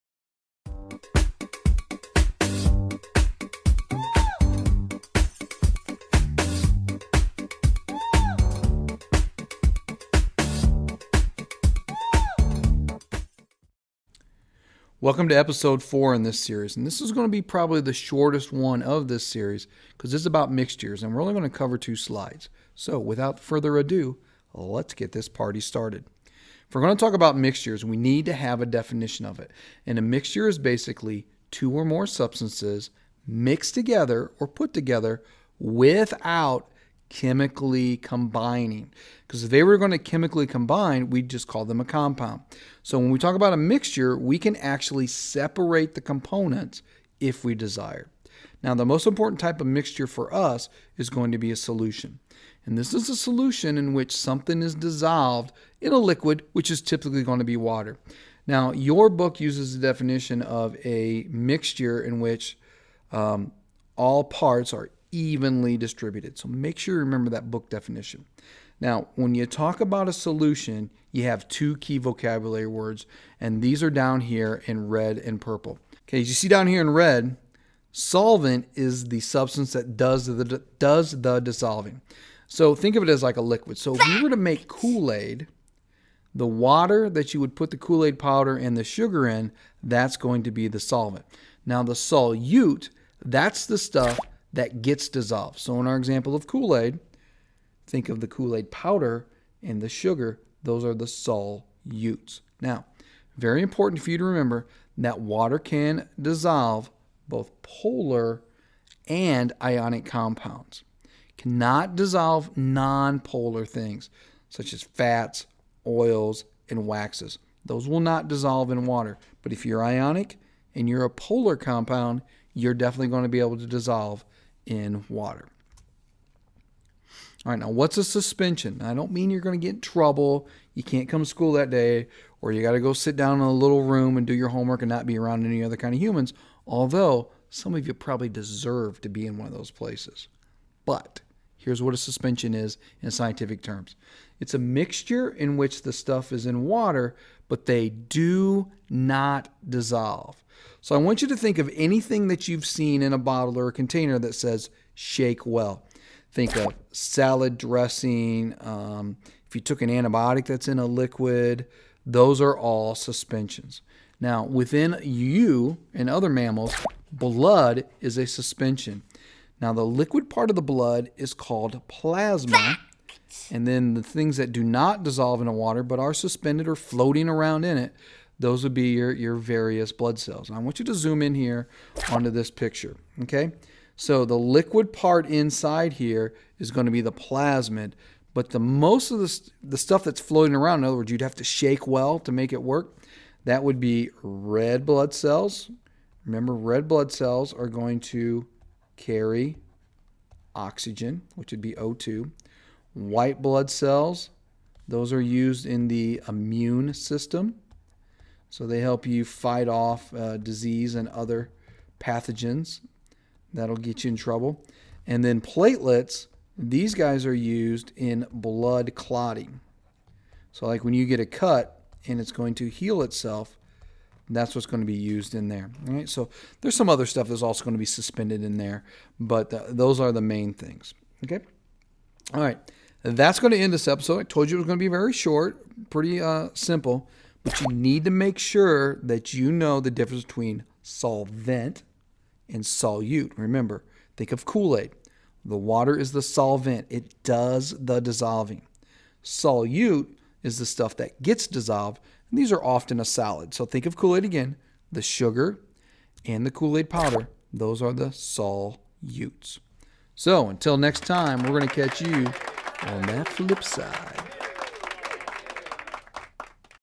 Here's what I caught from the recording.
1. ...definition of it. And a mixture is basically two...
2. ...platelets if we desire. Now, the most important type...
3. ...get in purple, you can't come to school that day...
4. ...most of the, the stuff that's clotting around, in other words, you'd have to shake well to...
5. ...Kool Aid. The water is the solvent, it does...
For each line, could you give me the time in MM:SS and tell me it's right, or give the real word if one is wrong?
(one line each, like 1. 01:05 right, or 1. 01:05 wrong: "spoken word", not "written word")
1. 00:28 right
2. 00:46 wrong: "components", not "platelets"
3. 02:09 wrong: "trouble", not "purple"
4. 03:08 wrong: "floating", not "clotting"
5. 04:04 right.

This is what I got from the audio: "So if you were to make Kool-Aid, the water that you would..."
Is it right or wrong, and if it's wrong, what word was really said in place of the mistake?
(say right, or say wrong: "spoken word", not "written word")
right.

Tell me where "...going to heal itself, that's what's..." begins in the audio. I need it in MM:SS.
03:42.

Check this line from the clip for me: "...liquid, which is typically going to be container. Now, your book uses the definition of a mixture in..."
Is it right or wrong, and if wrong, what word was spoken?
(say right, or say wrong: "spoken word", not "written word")
wrong: "water", not "container".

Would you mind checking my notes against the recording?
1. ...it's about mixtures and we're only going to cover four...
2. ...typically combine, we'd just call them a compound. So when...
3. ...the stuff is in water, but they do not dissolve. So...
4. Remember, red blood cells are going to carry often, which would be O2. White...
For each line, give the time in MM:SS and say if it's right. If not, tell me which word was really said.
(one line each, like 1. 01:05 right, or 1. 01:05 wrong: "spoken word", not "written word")
1. 00:20 wrong: "two", not "four"
2. 00:39 wrong: "chemically", not "typically"
3. 02:25 right
4. 03:16 wrong: "oxygen", not "often".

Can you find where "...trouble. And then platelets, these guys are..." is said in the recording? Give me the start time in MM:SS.
03:34.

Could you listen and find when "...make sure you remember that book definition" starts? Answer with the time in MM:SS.
01:06.